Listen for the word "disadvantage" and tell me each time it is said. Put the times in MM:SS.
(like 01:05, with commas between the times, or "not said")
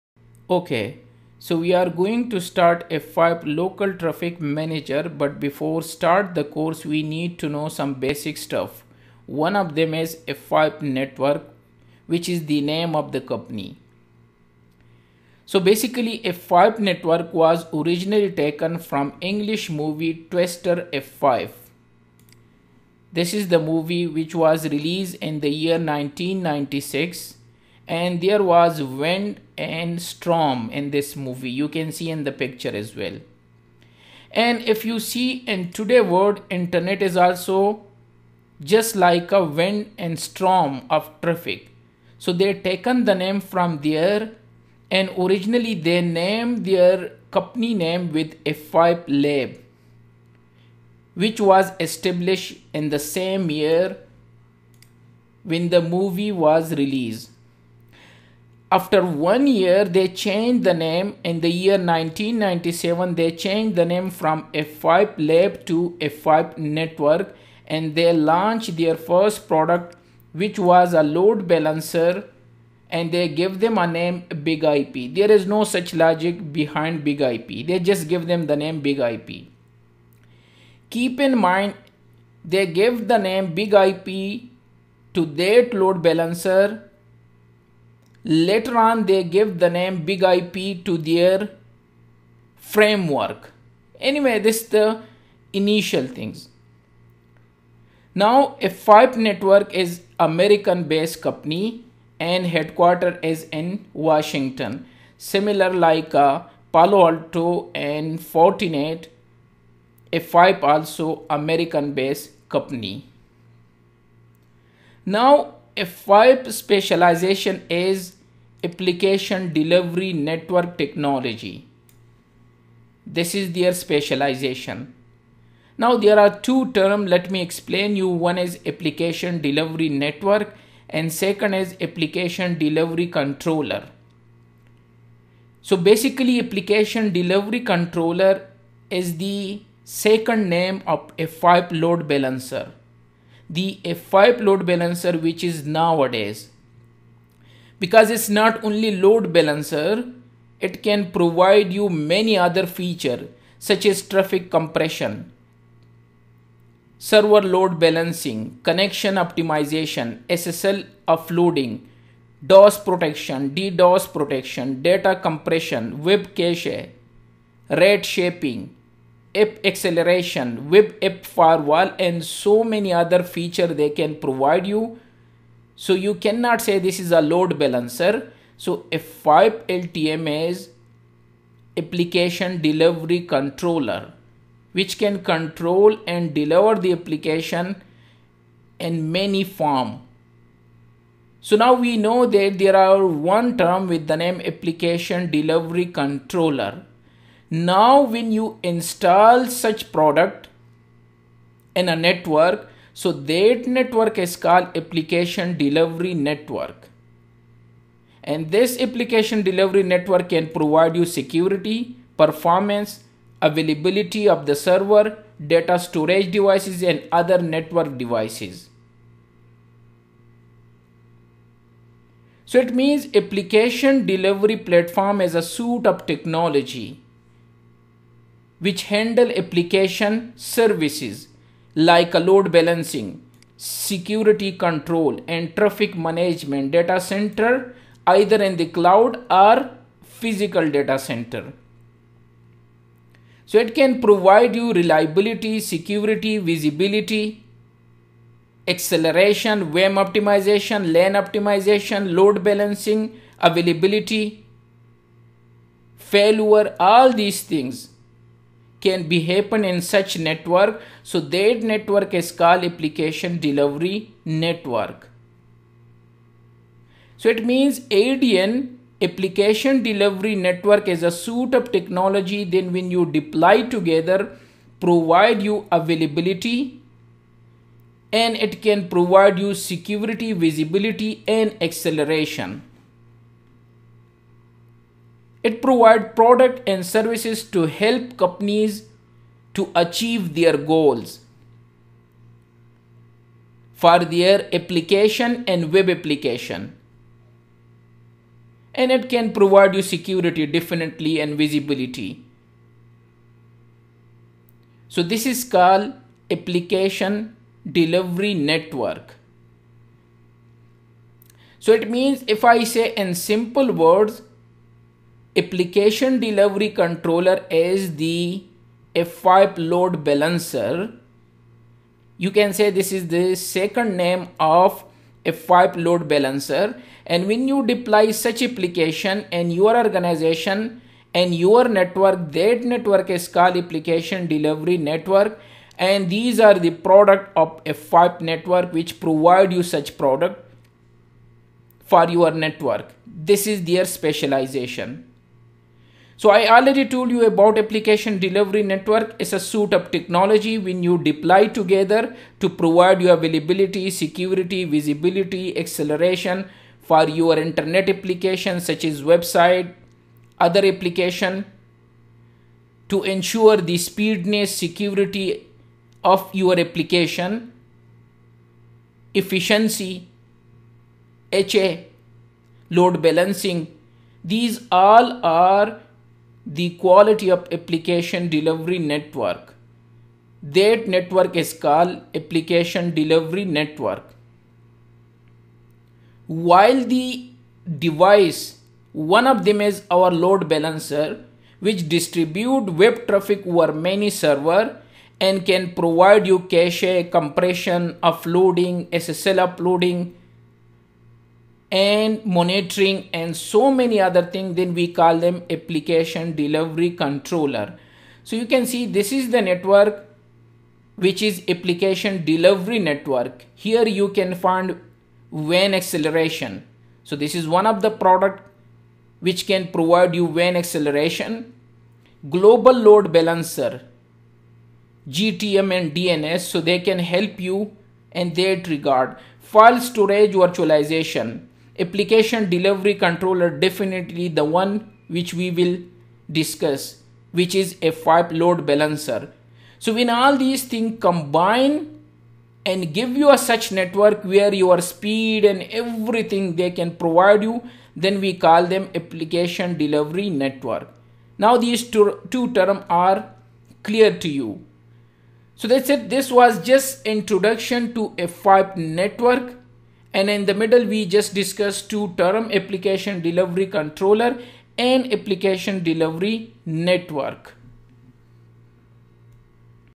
not said.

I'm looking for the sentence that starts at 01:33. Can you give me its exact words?
Anyway, this is the initial things.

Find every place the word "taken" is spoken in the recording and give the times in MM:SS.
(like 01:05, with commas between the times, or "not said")
00:18, 00:42.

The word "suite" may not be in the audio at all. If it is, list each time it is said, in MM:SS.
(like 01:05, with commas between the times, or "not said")
03:45, 04:31, 05:49.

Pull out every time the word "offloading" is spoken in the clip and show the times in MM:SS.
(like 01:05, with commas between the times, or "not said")
02:41, 06:39.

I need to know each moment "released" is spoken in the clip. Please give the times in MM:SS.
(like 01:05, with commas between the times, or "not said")
00:24, 00:56.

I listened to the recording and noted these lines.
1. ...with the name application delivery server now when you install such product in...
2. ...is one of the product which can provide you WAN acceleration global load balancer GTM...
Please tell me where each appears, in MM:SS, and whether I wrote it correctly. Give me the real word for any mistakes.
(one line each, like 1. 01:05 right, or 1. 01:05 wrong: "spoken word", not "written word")
1. 03:13 wrong: "controller", not "server"
2. 06:57 right.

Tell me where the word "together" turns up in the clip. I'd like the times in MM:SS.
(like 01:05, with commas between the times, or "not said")
04:33, 05:51.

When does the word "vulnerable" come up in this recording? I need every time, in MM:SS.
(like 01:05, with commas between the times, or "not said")
not said.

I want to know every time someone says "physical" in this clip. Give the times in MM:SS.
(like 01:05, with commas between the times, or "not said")
04:00.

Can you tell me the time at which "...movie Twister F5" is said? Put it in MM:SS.
00:19.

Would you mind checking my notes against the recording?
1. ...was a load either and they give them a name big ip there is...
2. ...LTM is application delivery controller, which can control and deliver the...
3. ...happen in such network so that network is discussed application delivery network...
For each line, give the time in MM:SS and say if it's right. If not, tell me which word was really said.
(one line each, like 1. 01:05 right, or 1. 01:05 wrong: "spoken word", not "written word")
1. 01:10 wrong: "balancer", not "either"
2. 02:59 right
3. 04:19 wrong: "called", not "discussed".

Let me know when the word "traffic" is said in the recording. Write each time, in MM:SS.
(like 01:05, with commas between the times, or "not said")
00:03, 00:41, 02:34, 03:55, 06:33.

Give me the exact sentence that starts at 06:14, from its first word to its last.
These all are the quality of application delivery network.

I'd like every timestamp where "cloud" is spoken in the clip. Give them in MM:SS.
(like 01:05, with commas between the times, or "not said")
03:58.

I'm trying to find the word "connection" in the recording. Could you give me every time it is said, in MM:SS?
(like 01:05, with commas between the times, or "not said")
02:38.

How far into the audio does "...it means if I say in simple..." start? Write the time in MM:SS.
05:11.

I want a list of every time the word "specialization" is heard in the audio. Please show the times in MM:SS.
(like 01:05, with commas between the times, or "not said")
01:56, 02:03, 05:43.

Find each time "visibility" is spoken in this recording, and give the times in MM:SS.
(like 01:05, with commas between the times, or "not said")
04:06, 04:40, 05:01, 05:54.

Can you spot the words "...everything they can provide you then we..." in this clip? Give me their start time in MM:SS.
07:25.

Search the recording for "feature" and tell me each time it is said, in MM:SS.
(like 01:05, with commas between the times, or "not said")
02:32, 02:53.